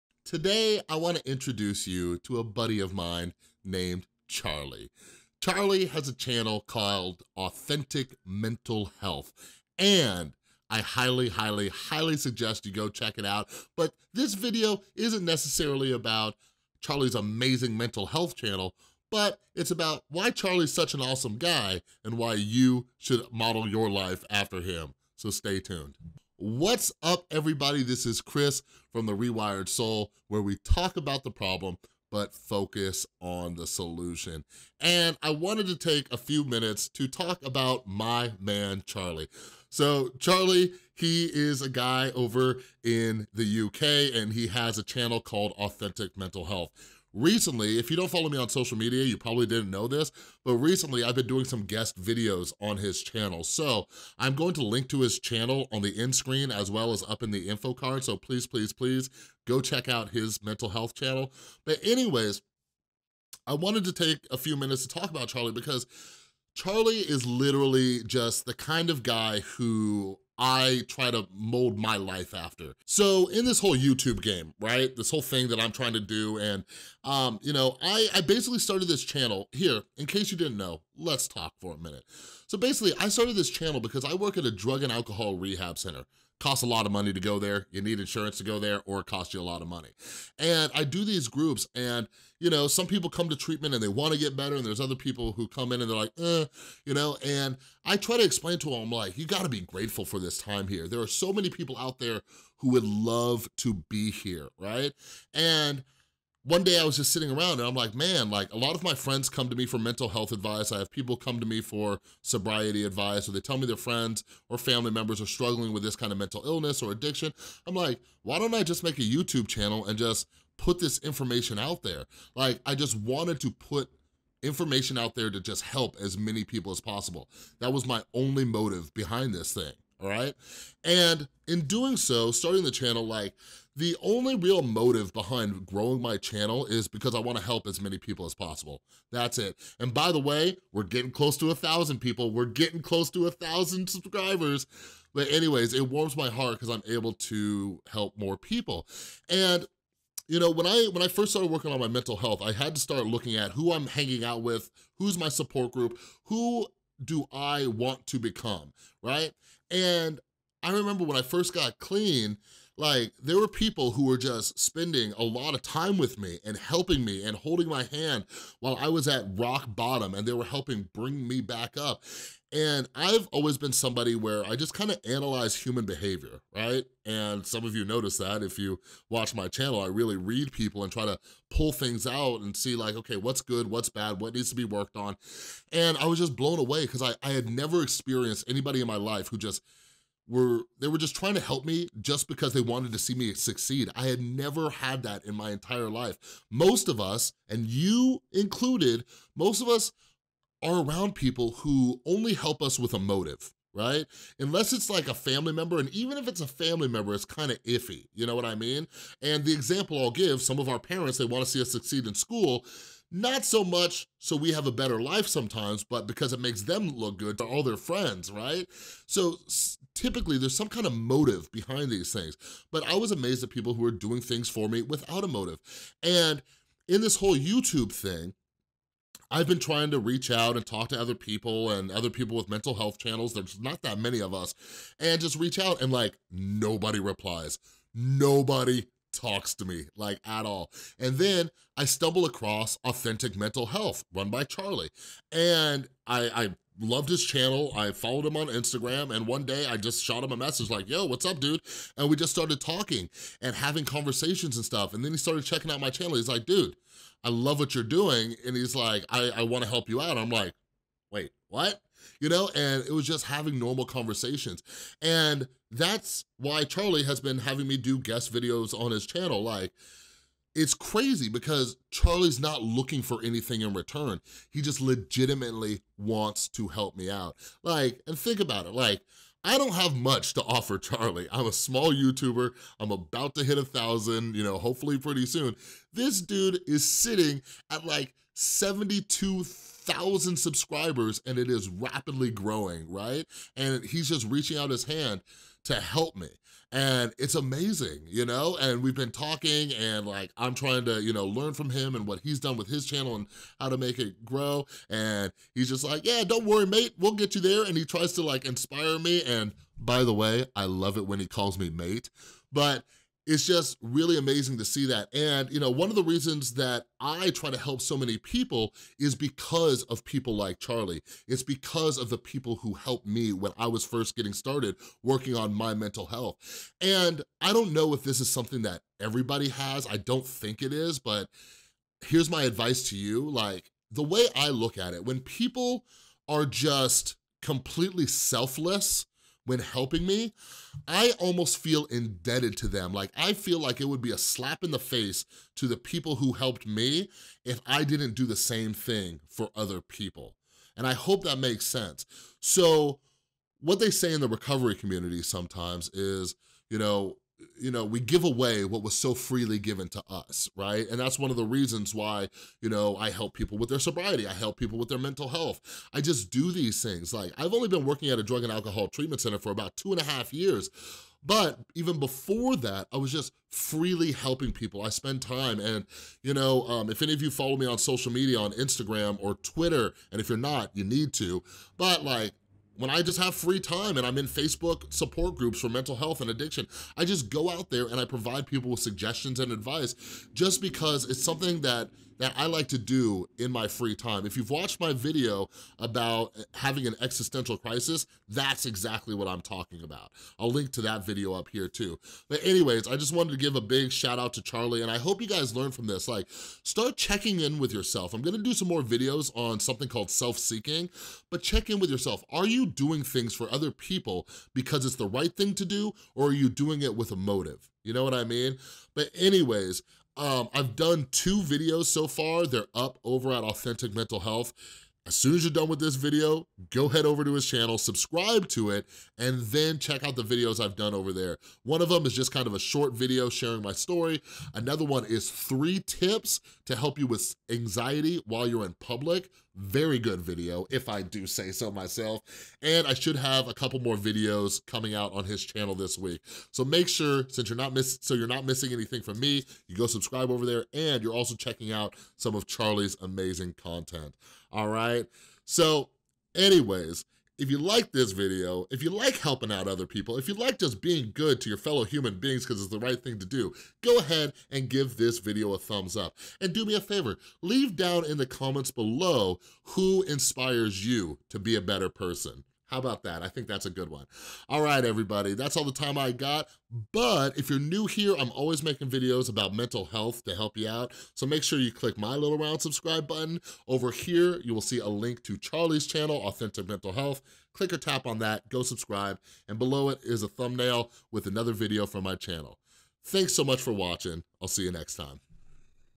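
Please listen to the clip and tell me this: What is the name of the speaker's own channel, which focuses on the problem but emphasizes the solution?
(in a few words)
The Rewired Soul.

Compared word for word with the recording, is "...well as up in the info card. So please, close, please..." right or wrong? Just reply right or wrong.
wrong.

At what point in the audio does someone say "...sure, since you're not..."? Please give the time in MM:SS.
07:26.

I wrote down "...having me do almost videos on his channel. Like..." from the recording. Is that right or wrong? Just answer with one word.
wrong.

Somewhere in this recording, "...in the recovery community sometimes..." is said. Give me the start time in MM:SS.
05:54.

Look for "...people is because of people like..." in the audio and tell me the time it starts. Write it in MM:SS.
05:18.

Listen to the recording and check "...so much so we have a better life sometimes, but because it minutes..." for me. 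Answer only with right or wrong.
wrong.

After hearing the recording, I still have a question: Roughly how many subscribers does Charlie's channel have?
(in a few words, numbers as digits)
72,000.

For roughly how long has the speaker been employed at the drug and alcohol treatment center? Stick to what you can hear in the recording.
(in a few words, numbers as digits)
2 and a half years.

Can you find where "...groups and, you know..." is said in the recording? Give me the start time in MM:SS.
01:31.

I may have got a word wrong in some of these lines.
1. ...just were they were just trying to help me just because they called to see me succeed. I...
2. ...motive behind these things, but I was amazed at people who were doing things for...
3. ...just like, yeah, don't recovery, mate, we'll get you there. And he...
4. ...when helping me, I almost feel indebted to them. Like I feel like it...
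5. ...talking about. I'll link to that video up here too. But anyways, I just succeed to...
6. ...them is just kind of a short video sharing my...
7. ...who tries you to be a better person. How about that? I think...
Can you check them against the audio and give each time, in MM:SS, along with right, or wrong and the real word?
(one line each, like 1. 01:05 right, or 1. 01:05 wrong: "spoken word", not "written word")
1. 03:09 wrong: "wanted", not "called"
2. 03:40 right
3. 05:05 wrong: "worry", not "recovery"
4. 05:39 right
5. 06:39 wrong: "wanted", not "succeed"
6. 07:11 right
7. 07:49 wrong: "inspires", not "tries".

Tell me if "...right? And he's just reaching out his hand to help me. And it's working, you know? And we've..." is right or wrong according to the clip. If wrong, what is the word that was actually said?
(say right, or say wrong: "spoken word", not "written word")
wrong: "amazing", not "working".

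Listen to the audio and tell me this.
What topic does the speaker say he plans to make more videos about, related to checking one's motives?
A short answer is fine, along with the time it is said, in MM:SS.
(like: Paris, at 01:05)
self-seeking, at 06:50.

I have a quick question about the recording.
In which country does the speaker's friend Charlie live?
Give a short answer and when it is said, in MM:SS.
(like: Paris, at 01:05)
UK, at 00:43.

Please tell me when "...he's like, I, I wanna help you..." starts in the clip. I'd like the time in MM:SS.
04:18.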